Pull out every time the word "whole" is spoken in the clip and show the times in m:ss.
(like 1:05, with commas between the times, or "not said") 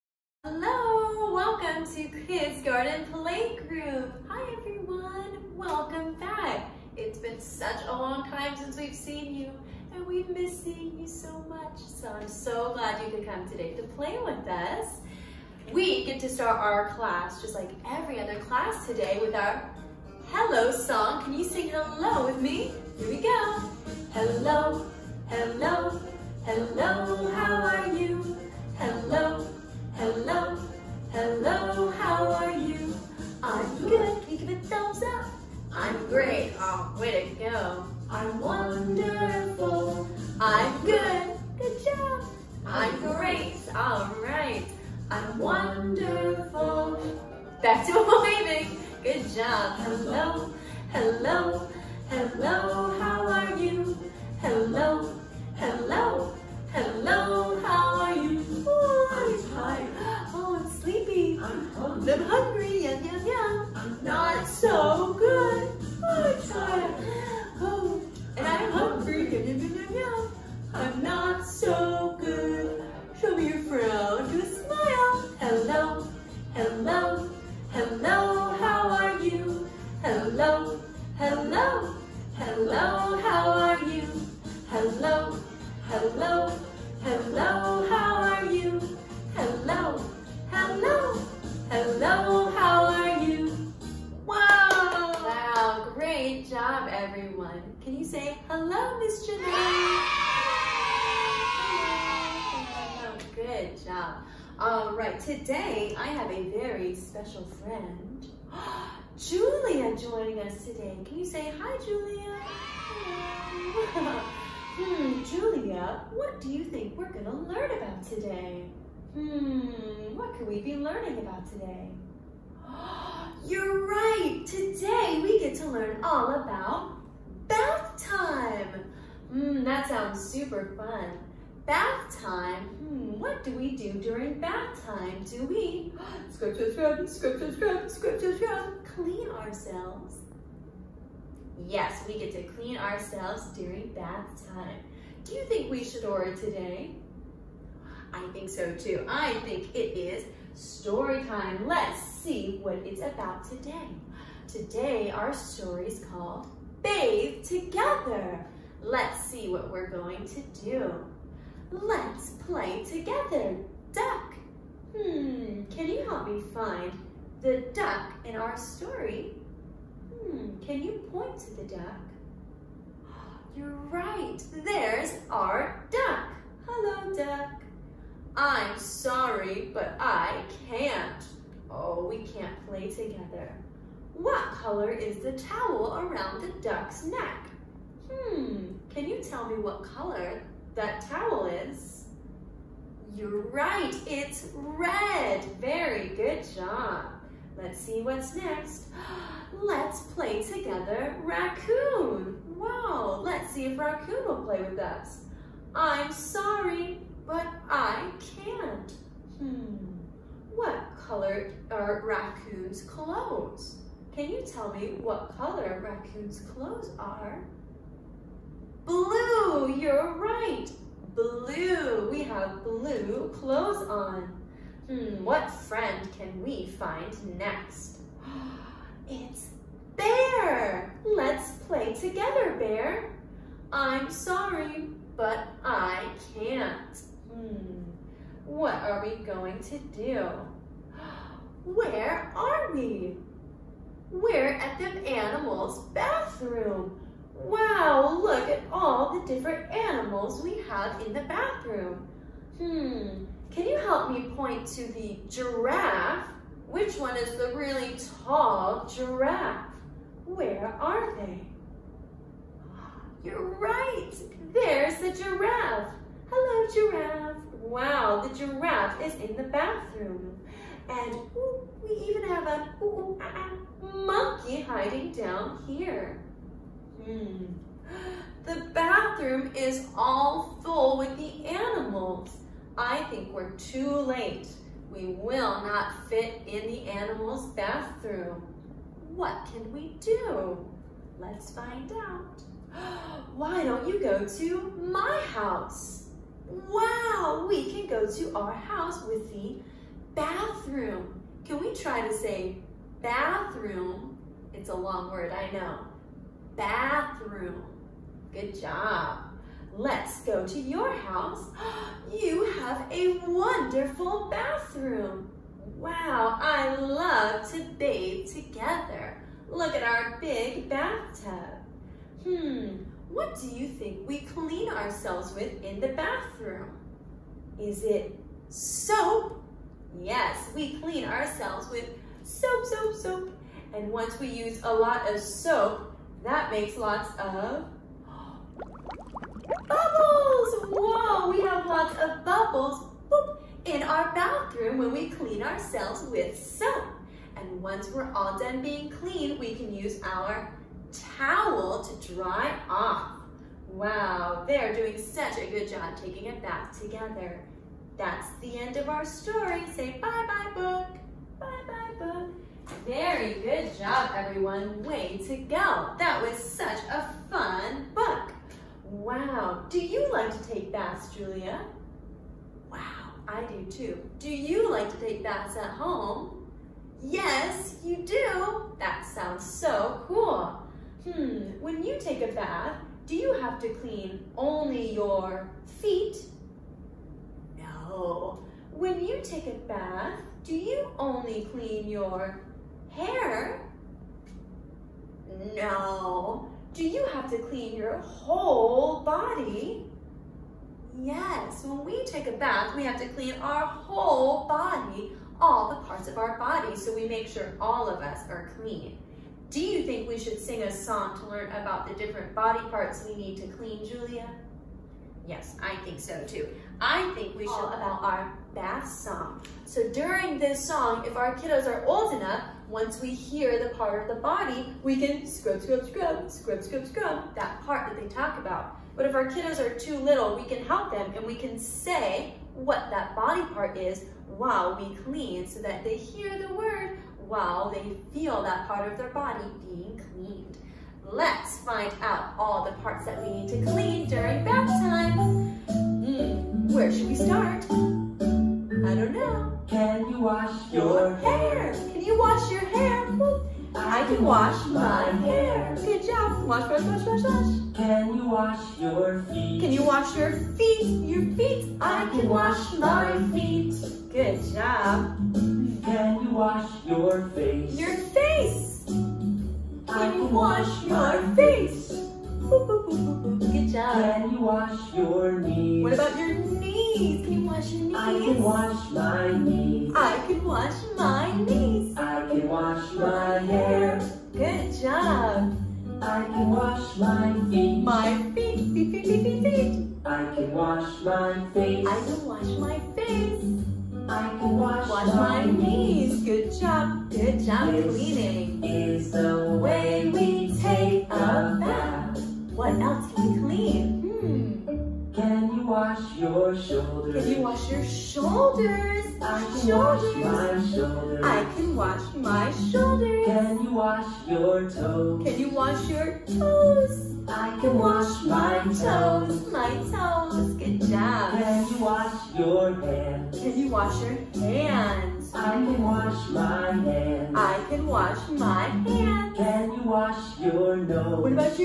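6:37, 6:43.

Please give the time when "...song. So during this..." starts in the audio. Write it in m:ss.
6:58.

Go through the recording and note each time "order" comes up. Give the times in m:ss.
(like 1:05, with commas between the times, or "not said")
2:26.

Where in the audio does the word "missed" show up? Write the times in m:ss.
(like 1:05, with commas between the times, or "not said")
0:10.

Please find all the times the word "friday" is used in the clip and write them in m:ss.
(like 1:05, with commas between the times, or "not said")
not said.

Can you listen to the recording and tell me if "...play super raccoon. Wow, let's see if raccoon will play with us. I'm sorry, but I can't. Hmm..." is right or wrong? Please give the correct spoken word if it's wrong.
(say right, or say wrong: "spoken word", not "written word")
wrong: "together", not "super".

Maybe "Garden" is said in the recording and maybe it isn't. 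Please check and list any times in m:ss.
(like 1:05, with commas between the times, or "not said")
0:02.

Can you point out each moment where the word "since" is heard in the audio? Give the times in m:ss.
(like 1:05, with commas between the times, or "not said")
0:08.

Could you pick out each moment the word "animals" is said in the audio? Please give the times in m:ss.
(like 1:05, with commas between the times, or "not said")
4:05, 4:09, 4:41, 4:46.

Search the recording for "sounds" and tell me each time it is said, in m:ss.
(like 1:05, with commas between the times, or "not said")
2:09, 6:19.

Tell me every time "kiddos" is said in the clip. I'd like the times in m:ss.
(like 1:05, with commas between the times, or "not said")
7:01, 7:09.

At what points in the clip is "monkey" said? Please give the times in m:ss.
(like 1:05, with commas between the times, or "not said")
4:33.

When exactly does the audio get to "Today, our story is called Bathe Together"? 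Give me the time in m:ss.
2:34.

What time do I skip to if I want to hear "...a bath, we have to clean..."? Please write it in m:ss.
6:42.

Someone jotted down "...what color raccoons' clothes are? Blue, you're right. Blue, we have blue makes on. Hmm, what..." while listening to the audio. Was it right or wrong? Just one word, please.
wrong.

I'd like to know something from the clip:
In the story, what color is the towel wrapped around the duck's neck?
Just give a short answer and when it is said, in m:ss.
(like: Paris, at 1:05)
Red, at 3:14.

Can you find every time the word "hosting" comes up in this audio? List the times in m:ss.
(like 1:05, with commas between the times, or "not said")
not said.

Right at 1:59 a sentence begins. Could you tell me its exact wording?
Hmm, what could we be learning about today?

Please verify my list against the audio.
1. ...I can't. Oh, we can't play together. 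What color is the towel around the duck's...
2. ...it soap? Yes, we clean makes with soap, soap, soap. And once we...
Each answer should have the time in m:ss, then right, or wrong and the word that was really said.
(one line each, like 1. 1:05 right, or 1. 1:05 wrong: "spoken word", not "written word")
1. 2:59 right
2. 5:27 wrong: "ourselves", not "makes".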